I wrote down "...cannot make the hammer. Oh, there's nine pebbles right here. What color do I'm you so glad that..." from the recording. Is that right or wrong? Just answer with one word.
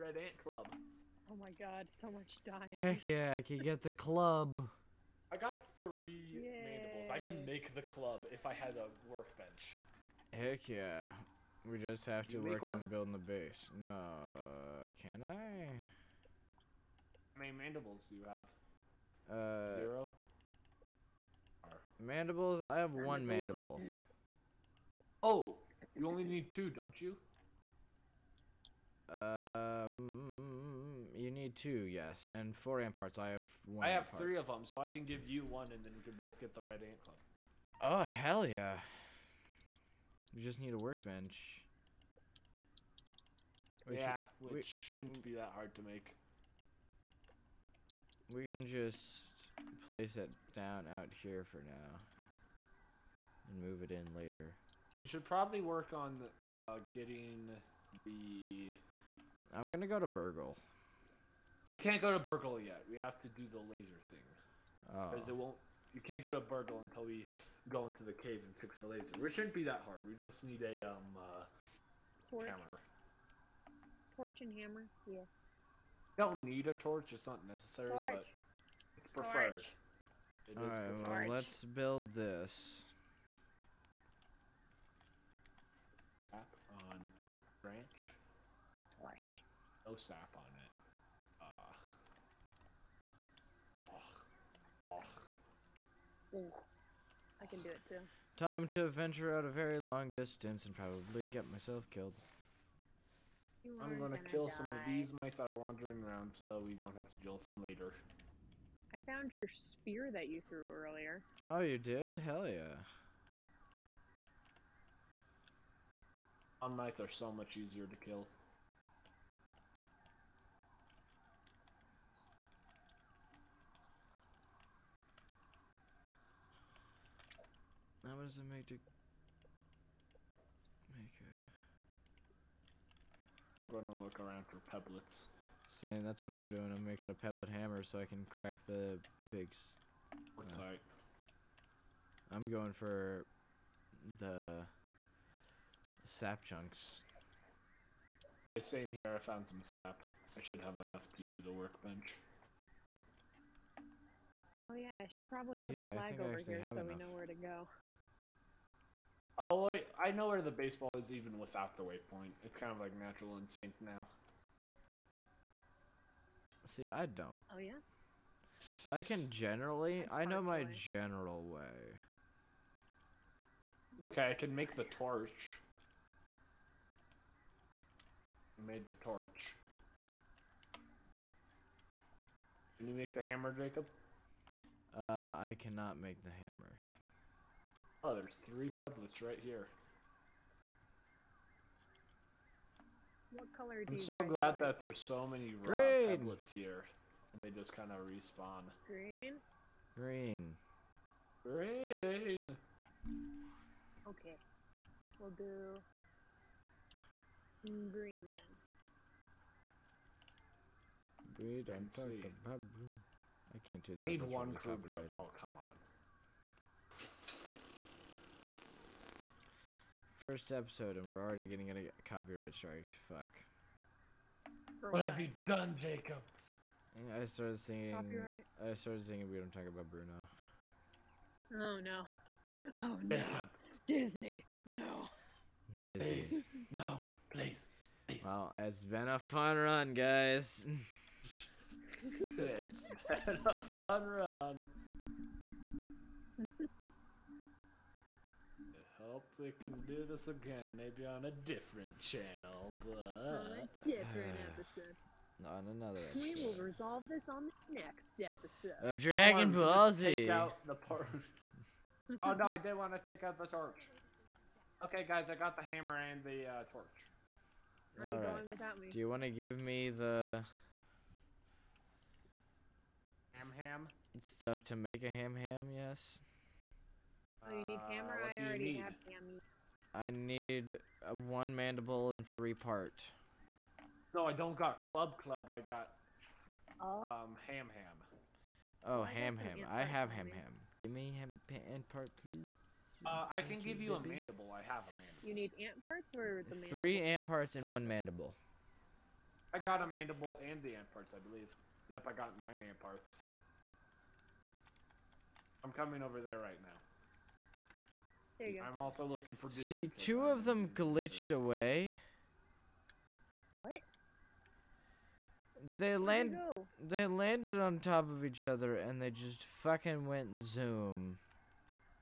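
wrong.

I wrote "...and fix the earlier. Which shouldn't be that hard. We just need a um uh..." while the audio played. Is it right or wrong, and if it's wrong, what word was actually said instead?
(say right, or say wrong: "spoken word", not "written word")
wrong: "laser", not "earlier".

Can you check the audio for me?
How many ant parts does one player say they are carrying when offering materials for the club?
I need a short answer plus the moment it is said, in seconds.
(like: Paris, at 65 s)
9, at 302 s.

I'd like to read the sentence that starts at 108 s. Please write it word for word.
I found your spear that you threw earlier.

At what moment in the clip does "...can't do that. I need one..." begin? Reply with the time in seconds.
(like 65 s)
213 s.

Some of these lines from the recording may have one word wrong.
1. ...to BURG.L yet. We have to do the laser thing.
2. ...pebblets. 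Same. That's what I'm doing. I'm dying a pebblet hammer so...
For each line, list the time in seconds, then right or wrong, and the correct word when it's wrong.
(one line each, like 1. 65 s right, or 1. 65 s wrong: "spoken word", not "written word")
1. 62 s right
2. 134 s wrong: "making", not "dying".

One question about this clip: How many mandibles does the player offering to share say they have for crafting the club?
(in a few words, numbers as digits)
3.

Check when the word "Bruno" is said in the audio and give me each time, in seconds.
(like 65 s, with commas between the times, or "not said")
229 s.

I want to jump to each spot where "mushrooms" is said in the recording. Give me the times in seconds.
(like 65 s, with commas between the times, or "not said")
not said.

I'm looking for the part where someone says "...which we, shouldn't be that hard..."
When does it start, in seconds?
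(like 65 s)
44 s.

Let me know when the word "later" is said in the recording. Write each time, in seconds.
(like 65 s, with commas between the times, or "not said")
54 s, 107 s.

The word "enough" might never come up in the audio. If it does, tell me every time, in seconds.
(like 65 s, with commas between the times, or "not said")
150 s, 156 s.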